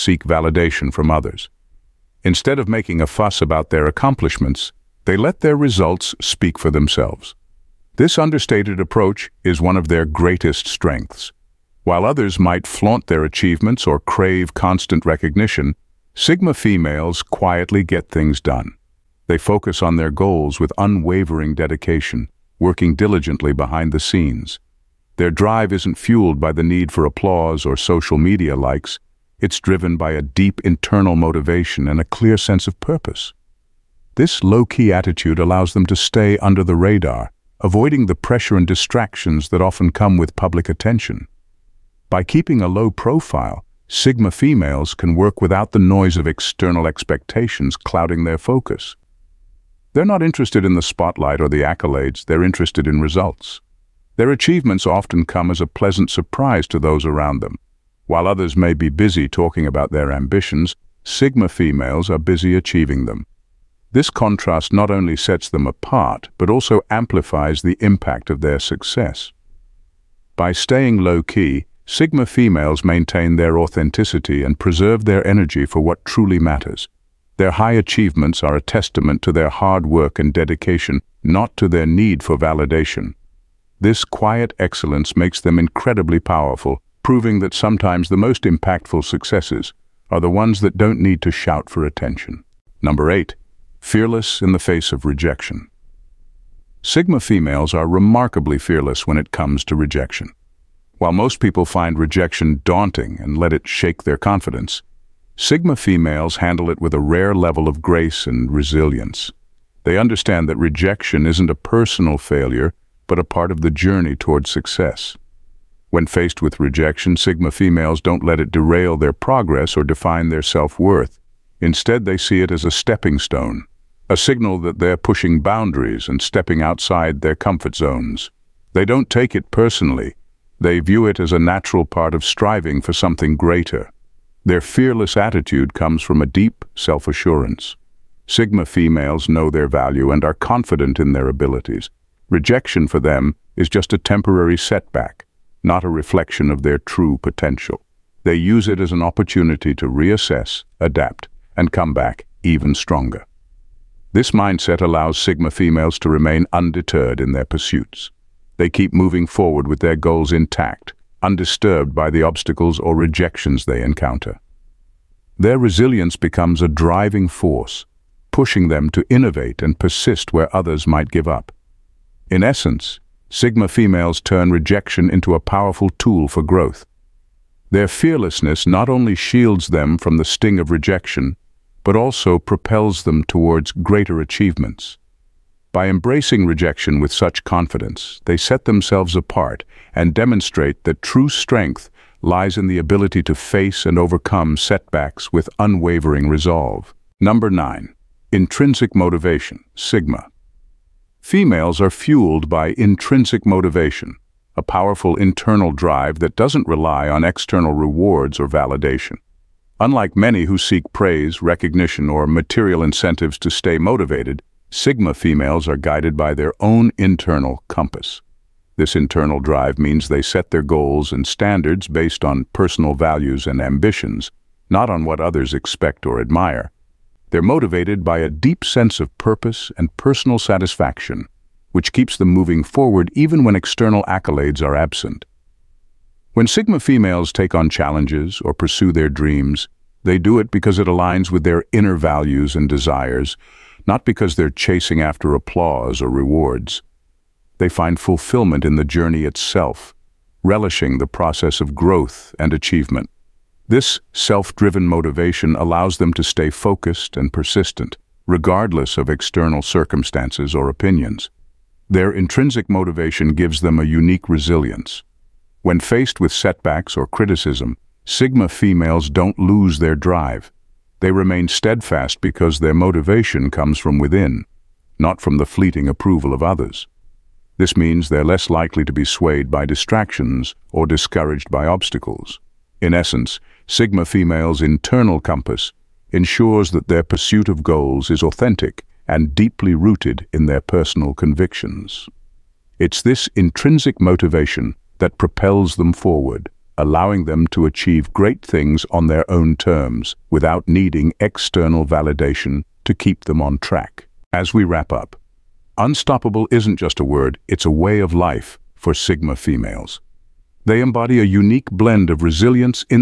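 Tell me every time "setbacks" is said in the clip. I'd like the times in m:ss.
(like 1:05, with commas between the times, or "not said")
2:24, 3:14, 4:26.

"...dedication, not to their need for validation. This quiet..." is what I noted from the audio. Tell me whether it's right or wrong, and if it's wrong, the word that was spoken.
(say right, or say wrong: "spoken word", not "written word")
right.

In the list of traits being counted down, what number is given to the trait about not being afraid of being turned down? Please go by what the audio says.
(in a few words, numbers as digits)
8.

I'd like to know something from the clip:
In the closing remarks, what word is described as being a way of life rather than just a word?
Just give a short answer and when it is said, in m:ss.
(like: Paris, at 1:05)
unstoppable, at 5:05.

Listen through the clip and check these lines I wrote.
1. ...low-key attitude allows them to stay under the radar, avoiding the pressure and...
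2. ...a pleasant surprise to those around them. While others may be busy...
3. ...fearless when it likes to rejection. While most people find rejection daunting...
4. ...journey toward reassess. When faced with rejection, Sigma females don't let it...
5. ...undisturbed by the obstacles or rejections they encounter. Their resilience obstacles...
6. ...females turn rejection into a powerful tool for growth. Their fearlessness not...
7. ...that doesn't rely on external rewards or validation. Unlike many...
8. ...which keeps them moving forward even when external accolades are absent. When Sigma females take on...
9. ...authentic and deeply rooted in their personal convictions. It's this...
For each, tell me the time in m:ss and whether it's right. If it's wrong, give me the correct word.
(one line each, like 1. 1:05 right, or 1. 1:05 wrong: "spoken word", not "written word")
1. 0:34 right
2. 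0:55 right
3. 1:38 wrong: "comes", not "likes"
4. 1:53 wrong: "success", not "reassess"
5. 2:41 wrong: "becomes", not "obstacles"
6. 2:53 right
7. 3:26 right
8. 3:51 right
9. 4:48 right.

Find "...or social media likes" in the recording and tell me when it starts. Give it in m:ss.
0:27.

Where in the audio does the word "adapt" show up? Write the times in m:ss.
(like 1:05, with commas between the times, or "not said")
2:30.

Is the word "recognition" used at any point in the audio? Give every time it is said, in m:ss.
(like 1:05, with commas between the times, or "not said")
0:15, 3:31.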